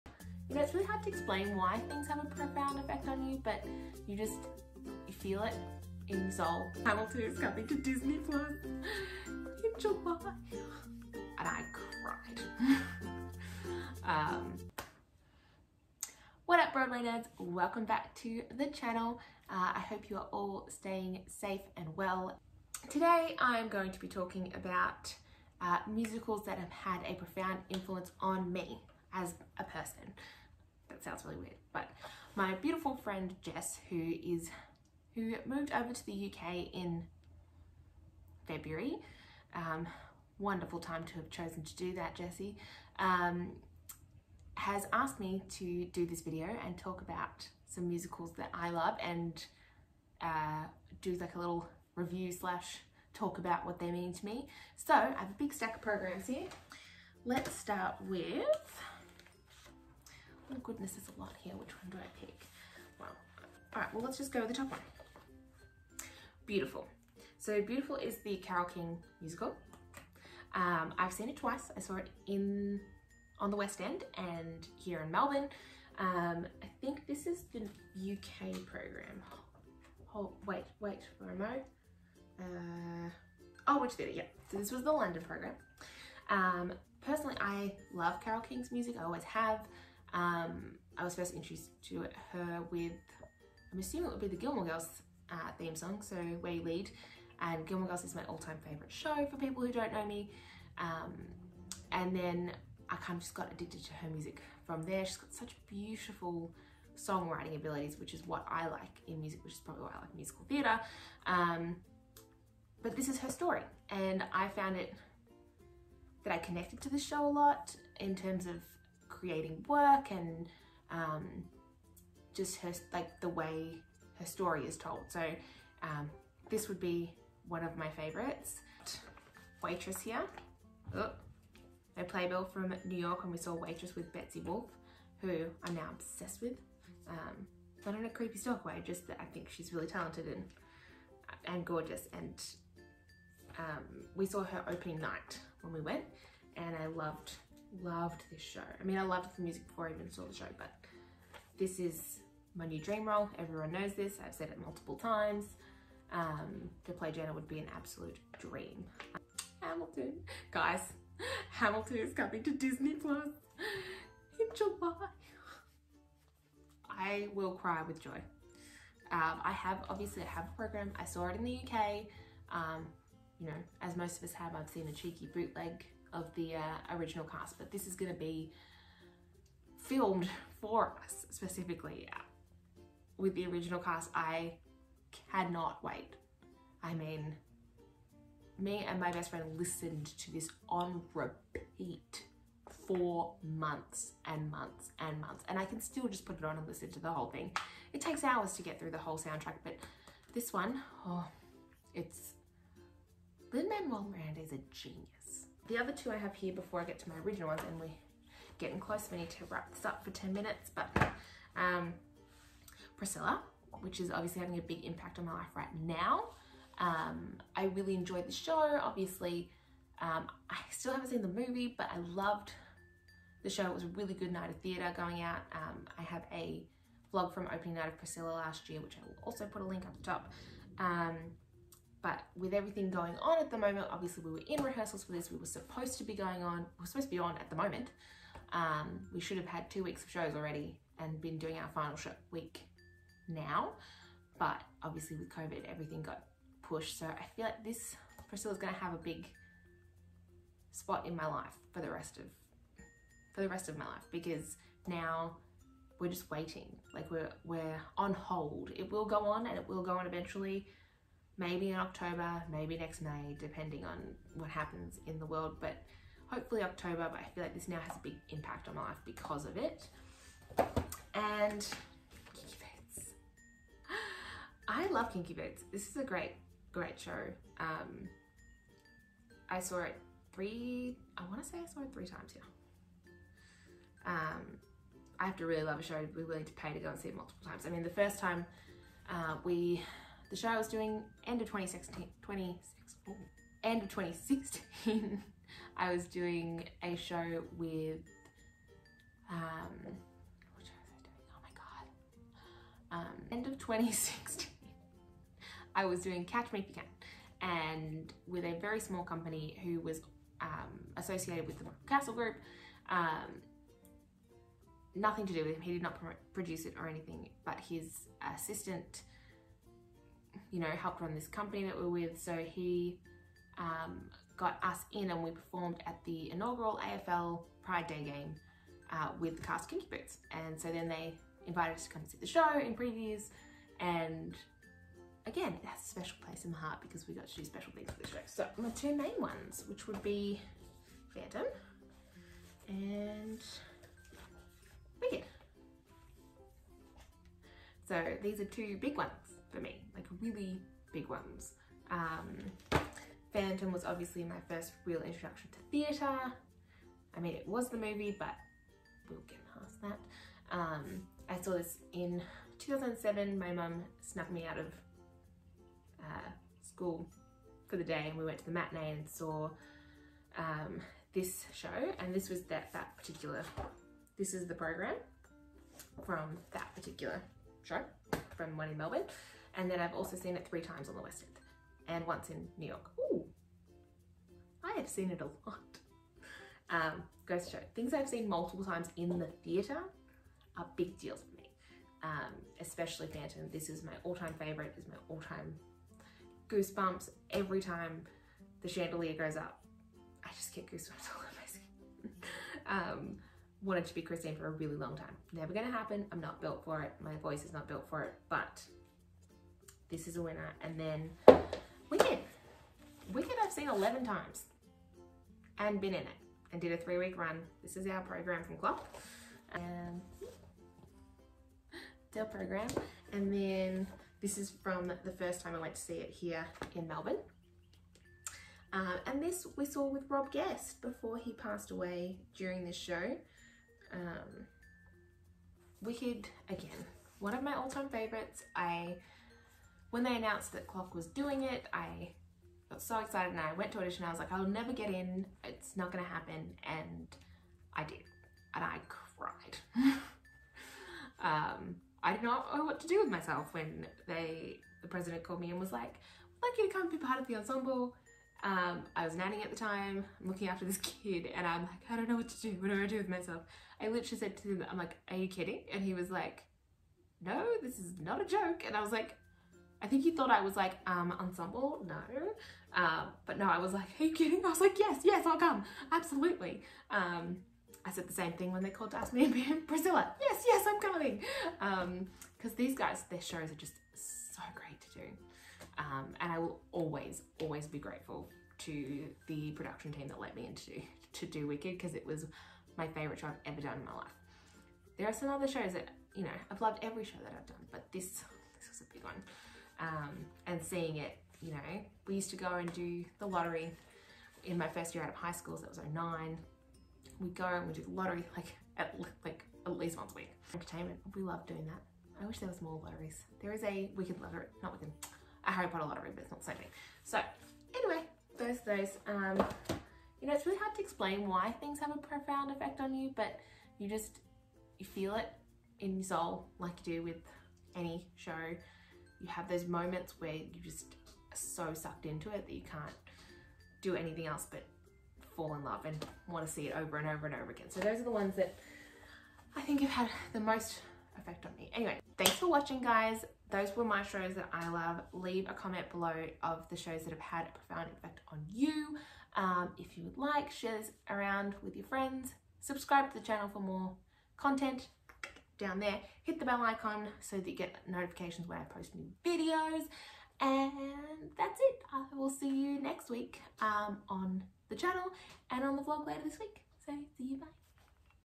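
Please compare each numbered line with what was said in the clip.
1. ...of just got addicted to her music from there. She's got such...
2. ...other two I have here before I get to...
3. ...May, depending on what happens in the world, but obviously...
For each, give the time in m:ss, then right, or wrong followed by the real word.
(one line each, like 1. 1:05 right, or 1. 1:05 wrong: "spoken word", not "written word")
1. 1:43 right
2. 3:25 right
3. 4:23 wrong: "hopefully", not "obviously".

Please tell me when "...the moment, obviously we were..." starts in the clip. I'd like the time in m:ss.
3:53.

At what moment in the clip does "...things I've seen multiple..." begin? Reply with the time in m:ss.
6:27.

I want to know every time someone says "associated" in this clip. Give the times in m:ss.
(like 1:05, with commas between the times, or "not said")
5:10.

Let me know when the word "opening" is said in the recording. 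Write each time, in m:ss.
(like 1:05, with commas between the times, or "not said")
2:24, 3:47.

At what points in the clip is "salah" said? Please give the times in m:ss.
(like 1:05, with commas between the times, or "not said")
not said.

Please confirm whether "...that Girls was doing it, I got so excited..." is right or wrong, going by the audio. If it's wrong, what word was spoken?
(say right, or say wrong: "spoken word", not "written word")
wrong: "CLOC", not "Girls".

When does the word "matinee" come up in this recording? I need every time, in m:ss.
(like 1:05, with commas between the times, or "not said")
6:08.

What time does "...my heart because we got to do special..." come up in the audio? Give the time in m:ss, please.
5:36.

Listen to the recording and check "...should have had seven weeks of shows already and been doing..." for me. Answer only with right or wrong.
wrong.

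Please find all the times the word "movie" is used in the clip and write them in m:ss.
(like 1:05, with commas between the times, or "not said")
3:41, 5:57.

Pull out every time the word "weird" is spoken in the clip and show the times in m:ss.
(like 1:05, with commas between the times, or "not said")
0:31.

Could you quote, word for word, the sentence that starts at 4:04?
But obviously with COVID, everything got pushed.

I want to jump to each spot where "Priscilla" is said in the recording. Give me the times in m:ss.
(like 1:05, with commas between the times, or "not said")
3:32, 3:47, 4:08, 7:59.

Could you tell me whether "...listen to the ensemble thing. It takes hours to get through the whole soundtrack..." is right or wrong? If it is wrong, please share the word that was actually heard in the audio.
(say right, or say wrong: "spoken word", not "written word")
wrong: "whole", not "ensemble".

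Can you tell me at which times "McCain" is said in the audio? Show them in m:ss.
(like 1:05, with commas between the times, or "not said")
not said.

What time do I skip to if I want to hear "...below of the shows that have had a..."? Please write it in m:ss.
9:05.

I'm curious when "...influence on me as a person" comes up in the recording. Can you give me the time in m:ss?
0:27.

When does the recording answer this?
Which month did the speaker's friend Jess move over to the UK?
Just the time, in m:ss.
0:38.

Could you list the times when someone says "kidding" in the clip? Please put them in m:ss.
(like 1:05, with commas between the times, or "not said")
7:45, 7:54.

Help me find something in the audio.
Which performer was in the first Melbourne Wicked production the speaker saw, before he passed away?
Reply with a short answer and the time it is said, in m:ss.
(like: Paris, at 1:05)
Rob Guest, at 7:10.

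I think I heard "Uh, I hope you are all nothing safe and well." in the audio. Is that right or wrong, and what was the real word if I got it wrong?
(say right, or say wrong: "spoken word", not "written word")
wrong: "staying", not "nothing".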